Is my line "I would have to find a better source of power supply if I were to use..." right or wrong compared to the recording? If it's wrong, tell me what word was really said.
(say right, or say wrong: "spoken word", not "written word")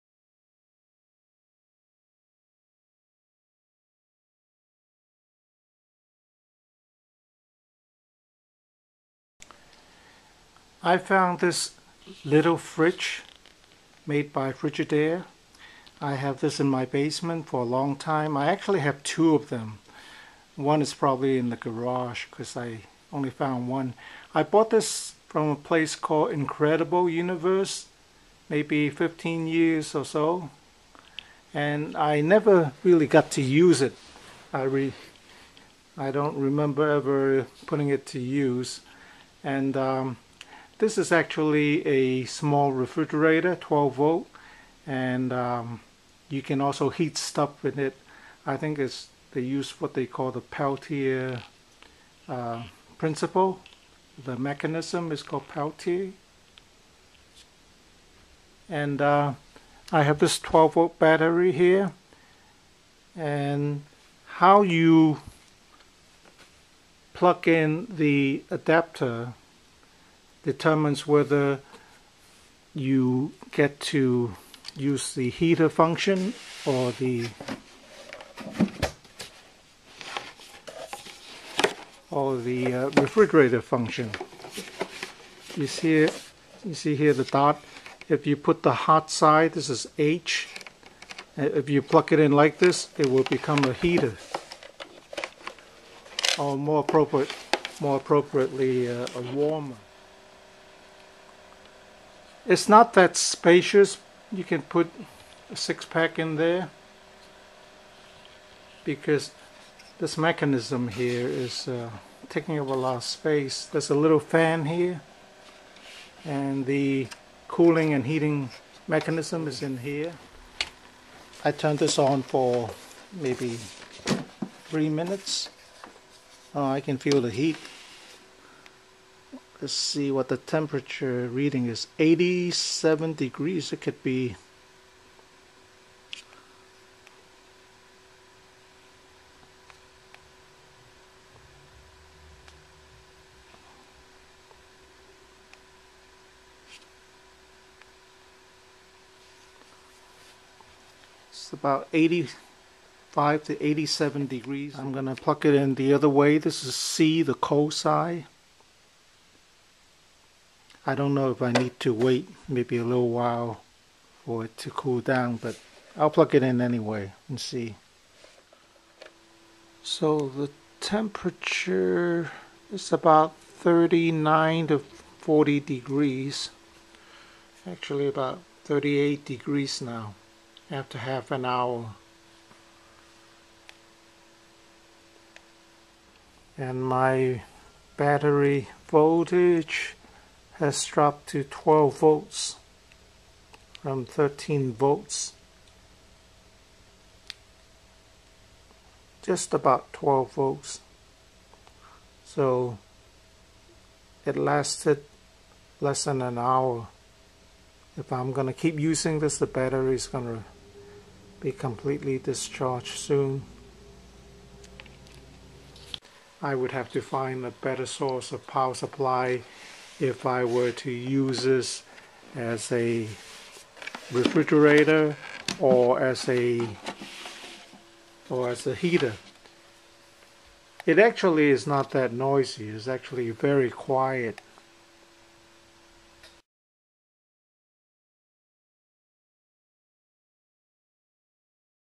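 right.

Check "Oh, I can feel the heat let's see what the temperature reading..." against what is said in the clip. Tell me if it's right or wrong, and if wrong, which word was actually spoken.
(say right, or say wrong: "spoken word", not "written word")
right.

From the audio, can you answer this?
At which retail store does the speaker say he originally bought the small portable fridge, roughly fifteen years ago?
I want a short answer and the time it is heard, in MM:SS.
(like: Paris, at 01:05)
Incredible Universe, at 00:26.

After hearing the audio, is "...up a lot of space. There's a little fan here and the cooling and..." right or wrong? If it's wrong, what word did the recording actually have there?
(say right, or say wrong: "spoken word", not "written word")
right.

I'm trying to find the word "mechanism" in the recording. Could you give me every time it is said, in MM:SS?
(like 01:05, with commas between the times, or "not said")
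00:54, 01:50, 01:58.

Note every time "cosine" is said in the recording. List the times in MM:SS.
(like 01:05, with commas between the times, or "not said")
02:37.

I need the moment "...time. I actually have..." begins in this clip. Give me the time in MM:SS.
00:17.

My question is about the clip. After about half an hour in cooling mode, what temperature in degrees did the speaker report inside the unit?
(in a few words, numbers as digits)
38 degrees.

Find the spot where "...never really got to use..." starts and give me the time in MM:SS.
00:32.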